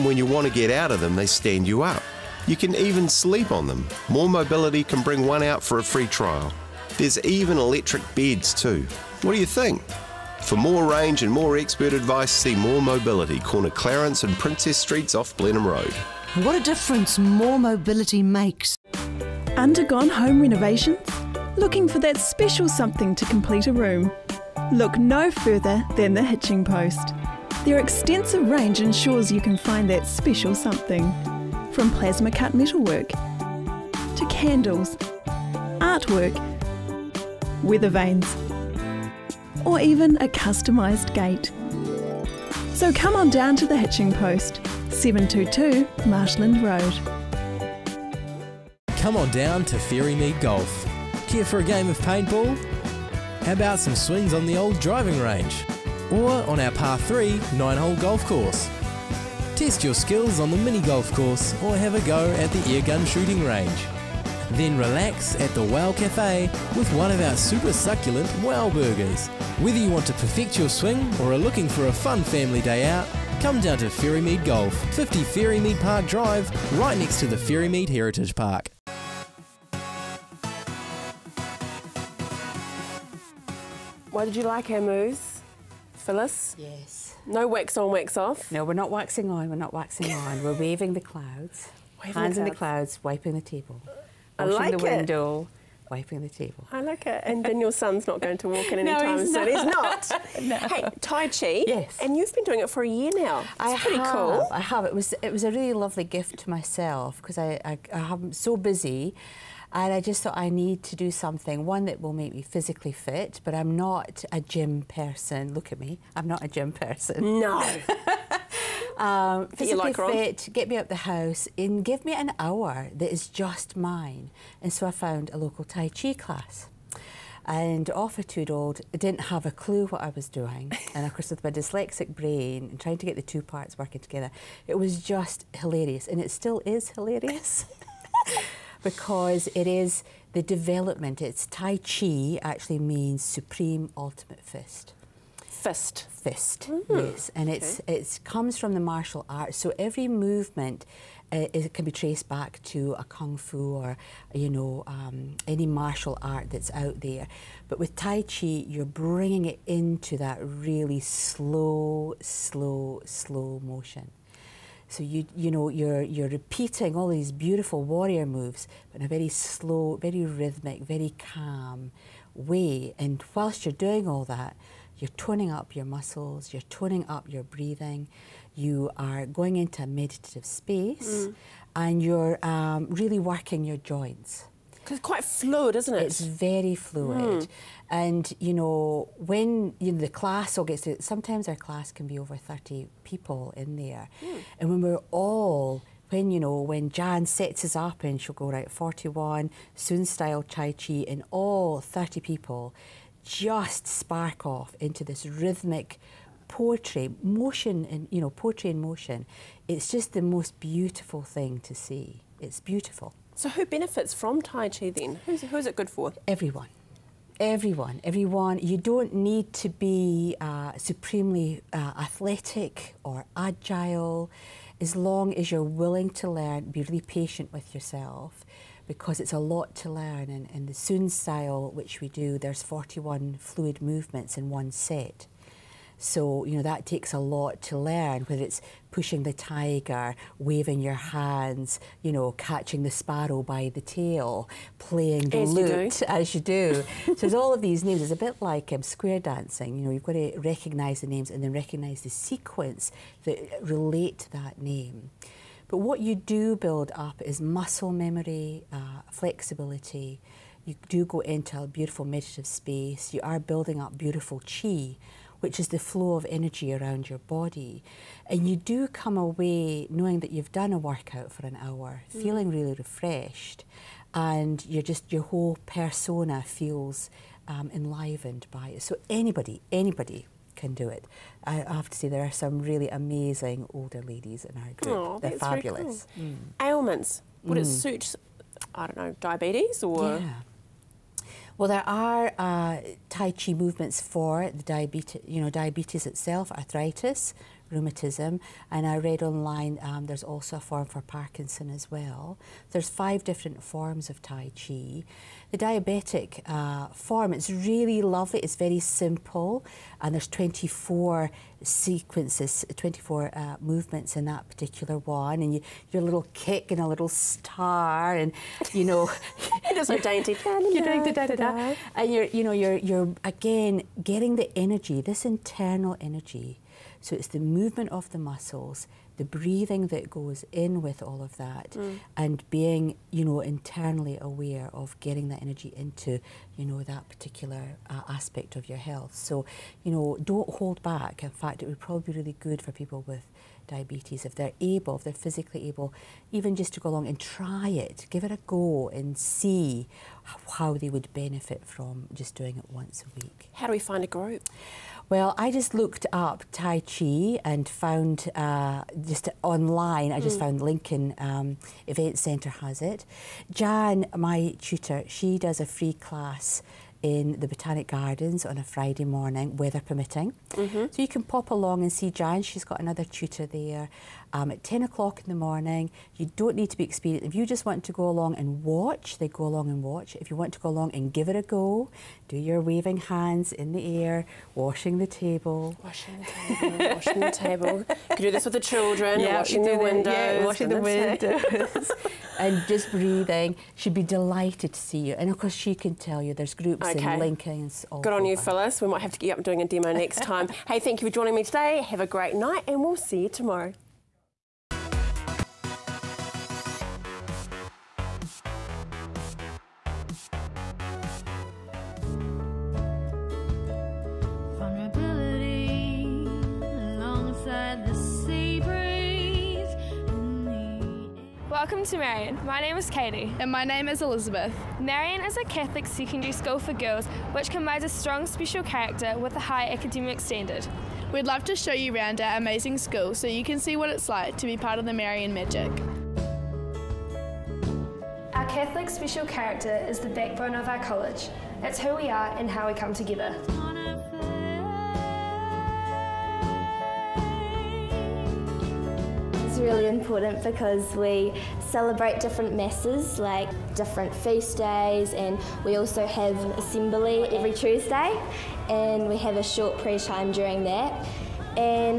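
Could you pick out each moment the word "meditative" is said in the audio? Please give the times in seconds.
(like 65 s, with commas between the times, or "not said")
179 s, 262 s.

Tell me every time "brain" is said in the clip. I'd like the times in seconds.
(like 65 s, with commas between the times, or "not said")
132 s.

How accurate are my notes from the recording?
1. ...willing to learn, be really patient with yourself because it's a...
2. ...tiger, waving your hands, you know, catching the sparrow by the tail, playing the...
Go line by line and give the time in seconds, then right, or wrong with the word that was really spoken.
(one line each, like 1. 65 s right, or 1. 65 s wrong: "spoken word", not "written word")
1. 225 s right
2. 239 s right.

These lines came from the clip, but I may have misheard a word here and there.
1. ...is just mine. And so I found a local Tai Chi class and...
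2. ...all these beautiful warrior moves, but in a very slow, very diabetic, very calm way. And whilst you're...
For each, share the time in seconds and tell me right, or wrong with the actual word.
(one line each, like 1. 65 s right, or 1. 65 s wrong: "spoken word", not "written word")
1. 123 s right
2. 166 s wrong: "rhythmic", not "diabetic".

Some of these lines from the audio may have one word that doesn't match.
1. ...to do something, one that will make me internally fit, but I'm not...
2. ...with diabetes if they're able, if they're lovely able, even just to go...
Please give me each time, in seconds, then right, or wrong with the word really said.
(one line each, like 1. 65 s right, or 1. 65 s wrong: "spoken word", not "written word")
1. 110 s wrong: "physically", not "internally"
2. 343 s wrong: "physically", not "lovely".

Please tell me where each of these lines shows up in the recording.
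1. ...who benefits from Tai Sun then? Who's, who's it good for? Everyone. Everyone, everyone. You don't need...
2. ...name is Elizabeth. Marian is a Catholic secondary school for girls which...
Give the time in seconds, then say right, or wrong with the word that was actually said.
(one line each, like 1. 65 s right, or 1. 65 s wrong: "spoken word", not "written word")
1. 213 s wrong: "Chi", not "Sun"
2. 423 s right.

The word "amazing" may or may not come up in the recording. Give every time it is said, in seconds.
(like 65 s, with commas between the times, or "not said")
282 s, 432 s.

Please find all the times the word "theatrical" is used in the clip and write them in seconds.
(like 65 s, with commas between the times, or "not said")
not said.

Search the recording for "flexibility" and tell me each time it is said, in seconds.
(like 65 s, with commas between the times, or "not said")
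259 s.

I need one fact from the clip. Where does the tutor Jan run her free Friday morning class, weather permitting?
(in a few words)
Botanic Gardens.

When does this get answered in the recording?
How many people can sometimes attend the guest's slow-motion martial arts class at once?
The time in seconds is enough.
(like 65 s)
192 s.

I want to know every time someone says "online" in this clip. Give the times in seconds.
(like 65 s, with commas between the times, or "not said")
299 s, 359 s.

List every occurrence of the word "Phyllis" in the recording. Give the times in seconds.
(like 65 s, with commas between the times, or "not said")
85 s, 398 s.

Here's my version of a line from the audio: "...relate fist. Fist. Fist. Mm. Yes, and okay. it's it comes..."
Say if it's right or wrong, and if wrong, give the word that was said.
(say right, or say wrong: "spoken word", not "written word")
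wrong: "ultimate", not "relate".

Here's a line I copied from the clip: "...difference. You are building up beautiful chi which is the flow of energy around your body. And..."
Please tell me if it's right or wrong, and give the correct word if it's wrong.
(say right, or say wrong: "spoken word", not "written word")
wrong: "space", not "difference".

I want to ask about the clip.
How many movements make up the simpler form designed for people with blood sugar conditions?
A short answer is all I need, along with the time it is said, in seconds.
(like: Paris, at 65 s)
24, at 312 s.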